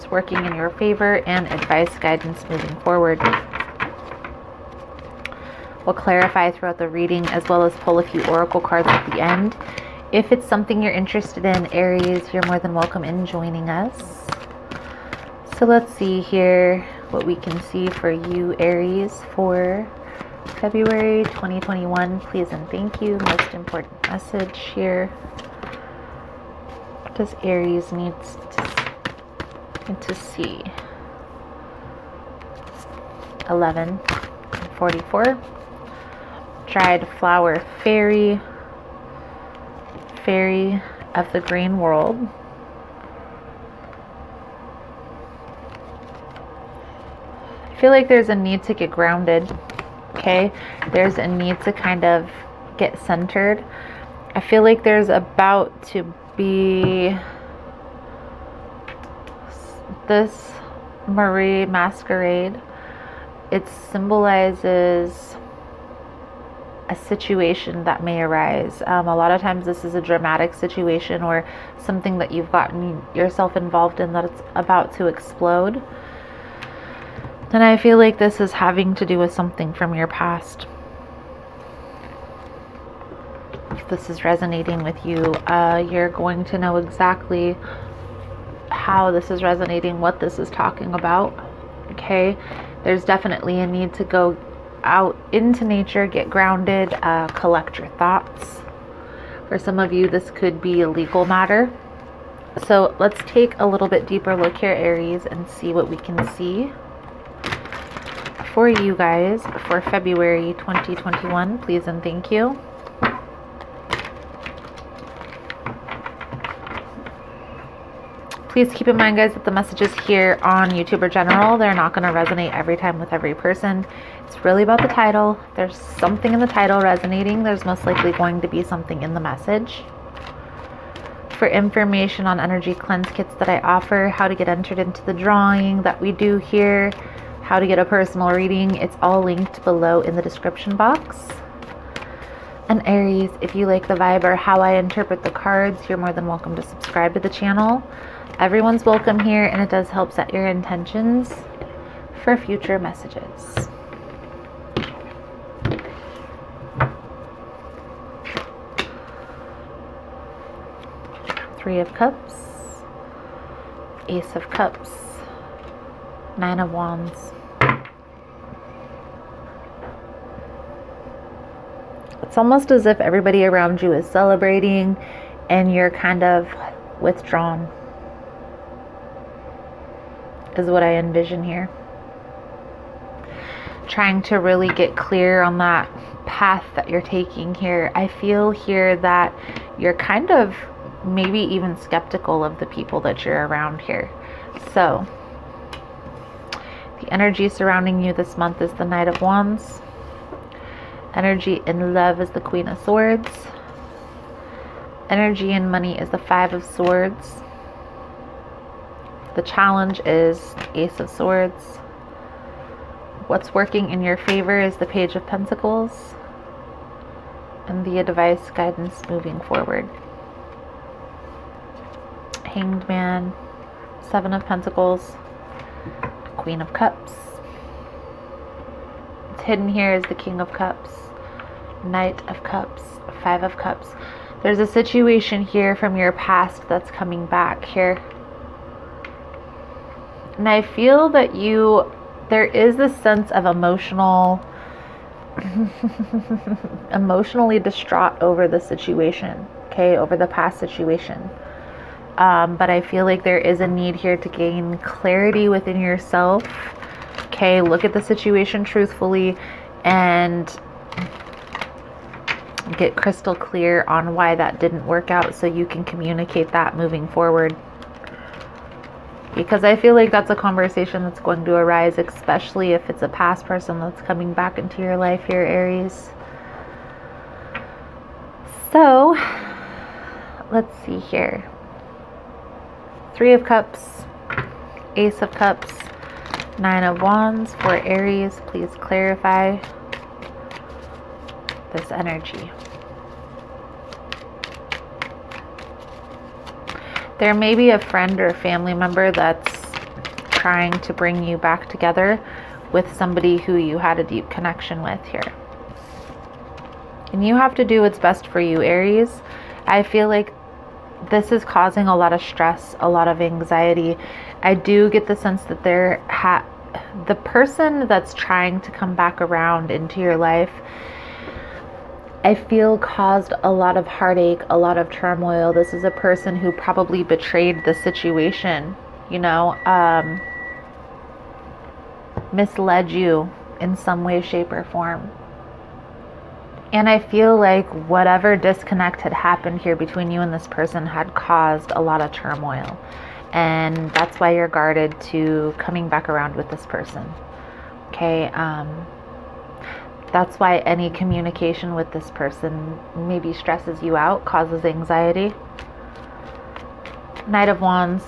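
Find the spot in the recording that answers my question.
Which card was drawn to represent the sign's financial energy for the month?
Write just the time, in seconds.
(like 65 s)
206 s.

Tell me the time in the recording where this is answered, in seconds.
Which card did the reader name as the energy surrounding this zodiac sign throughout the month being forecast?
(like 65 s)
198 s.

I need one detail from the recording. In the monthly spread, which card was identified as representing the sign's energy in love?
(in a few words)
Queen of Swords.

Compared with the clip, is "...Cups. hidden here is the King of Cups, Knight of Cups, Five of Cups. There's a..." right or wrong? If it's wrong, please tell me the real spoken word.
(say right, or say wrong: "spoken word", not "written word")
right.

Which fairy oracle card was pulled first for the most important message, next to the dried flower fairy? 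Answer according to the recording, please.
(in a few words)
Fairy of the Green World.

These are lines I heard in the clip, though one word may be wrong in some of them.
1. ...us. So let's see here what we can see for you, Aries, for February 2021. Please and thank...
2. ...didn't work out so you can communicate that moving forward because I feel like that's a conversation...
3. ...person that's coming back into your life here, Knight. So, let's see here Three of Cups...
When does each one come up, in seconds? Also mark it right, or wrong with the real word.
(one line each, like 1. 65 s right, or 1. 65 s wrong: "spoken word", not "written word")
1. 13 s right
2. 264 s right
3. 273 s wrong: "Aries", not "Knight".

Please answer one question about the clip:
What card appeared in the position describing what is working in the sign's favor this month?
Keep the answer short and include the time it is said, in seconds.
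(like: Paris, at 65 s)
Page of Pentacles, at 214 s.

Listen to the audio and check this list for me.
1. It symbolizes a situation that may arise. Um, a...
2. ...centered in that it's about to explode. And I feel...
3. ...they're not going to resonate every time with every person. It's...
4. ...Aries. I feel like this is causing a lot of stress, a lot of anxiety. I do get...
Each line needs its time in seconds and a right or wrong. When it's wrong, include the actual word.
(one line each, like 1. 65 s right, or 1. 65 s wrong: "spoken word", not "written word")
1. 63 s right
2. 73 s wrong: "involved", not "centered"
3. 121 s right
4. 308 s right.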